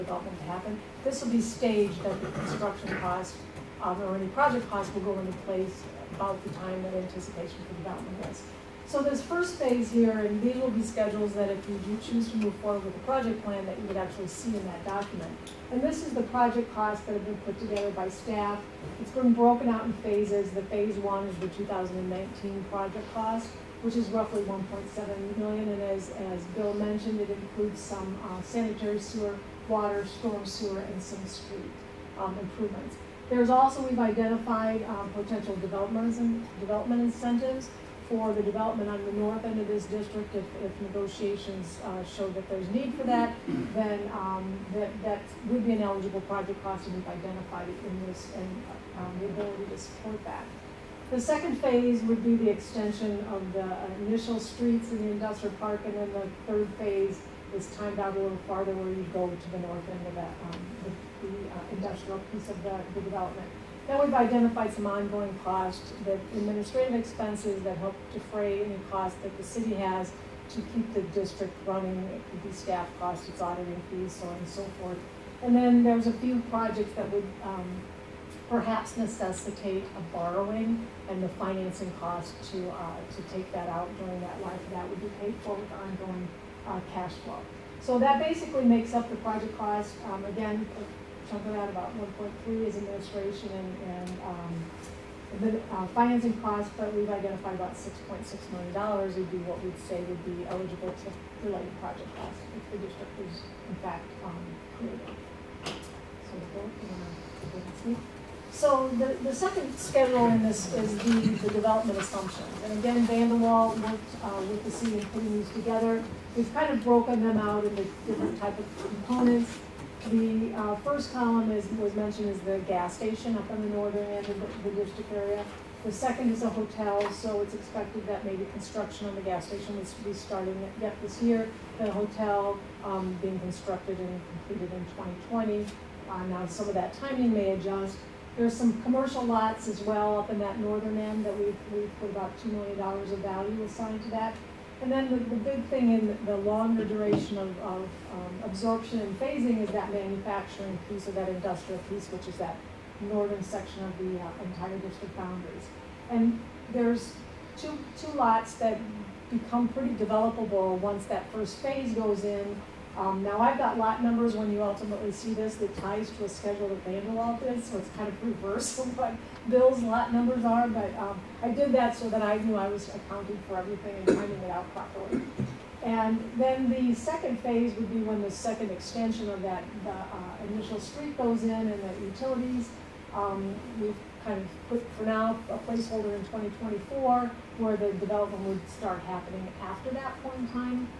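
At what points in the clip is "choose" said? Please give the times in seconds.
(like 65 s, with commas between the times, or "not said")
12 s.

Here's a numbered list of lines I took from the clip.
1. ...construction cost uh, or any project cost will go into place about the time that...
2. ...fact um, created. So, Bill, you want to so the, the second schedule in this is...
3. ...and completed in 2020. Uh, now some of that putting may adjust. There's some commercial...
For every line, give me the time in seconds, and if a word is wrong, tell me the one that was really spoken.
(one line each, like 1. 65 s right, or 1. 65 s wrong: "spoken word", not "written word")
1. 2 s right
2. 103 s right
3. 133 s wrong: "timing", not "putting".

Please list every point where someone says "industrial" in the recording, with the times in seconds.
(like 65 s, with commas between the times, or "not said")
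55 s, 61 s, 151 s.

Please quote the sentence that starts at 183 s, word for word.
Um, we've kind of put for now a placeholder in 2024 where the development would start happening after that point in time.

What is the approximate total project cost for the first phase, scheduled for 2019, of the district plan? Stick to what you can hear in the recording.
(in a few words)
1.7 million.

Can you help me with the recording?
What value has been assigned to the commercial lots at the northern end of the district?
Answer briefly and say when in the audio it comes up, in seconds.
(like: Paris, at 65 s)
$2 million, at 142 s.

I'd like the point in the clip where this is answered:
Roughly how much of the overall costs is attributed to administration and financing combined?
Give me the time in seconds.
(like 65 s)
91 s.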